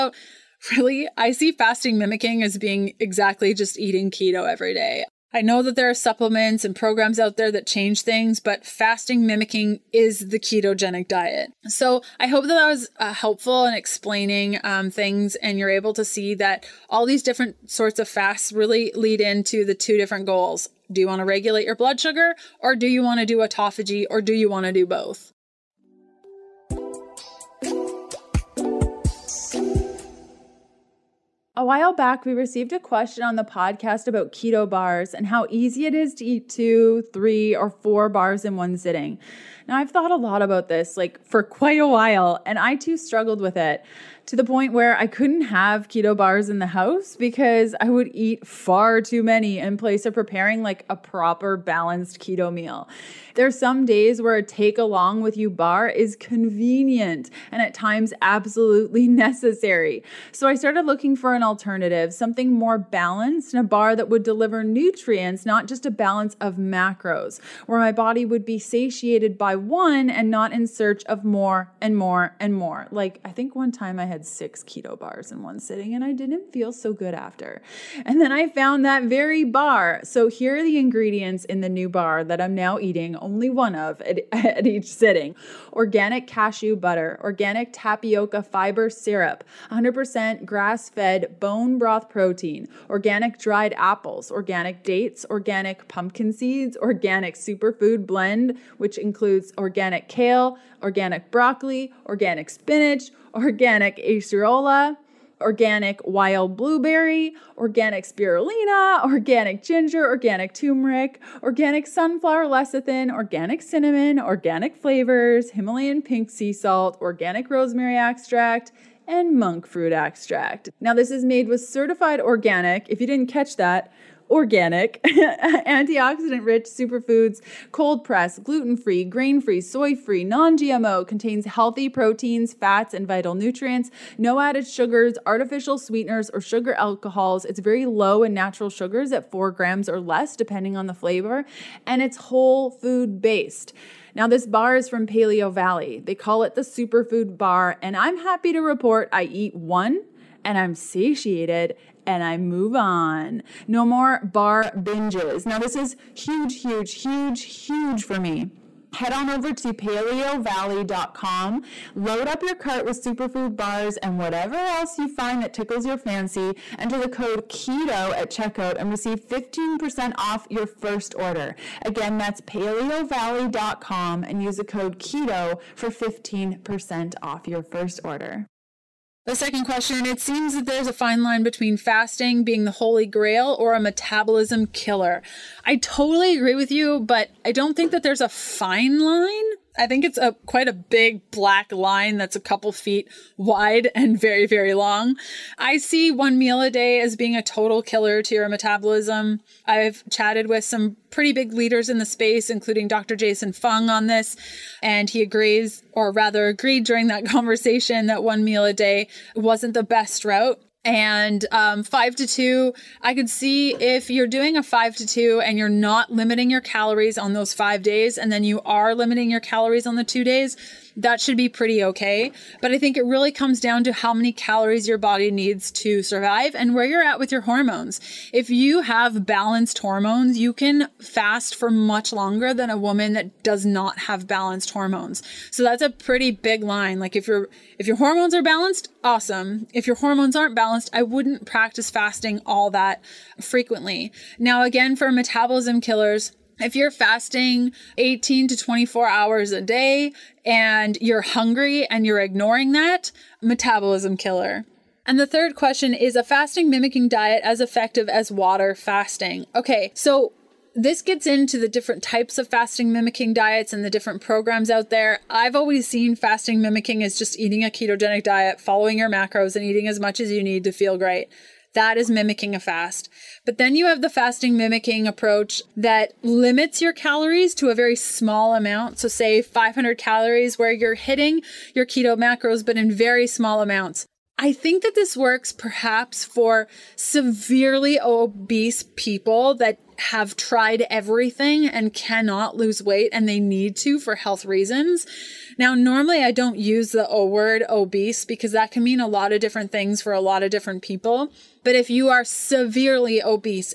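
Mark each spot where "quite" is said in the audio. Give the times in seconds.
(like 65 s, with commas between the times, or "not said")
41 s, 190 s.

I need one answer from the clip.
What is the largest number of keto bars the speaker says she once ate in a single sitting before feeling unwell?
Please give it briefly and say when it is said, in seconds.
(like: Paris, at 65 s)
6, at 74 s.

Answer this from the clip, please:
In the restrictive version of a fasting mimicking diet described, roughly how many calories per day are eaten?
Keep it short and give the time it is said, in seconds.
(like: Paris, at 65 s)
500, at 279 s.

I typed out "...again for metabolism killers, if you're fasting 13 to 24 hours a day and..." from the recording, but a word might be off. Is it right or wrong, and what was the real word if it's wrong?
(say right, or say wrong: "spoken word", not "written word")
wrong: "18", not "13".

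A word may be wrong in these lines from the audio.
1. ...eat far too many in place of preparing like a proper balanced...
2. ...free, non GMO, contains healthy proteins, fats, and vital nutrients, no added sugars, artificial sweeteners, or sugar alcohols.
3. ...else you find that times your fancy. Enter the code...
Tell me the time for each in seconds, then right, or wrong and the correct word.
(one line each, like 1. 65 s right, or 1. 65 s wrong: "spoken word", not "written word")
1. 48 s right
2. 129 s right
3. 164 s wrong: "tickles", not "times".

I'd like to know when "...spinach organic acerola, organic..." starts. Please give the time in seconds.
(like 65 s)
102 s.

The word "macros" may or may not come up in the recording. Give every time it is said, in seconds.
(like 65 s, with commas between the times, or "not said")
66 s, 269 s, 282 s.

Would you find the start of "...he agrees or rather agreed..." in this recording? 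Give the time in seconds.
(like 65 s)
205 s.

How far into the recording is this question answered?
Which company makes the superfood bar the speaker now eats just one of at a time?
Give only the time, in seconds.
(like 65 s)
145 s.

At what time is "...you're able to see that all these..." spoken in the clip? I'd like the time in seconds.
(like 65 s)
15 s.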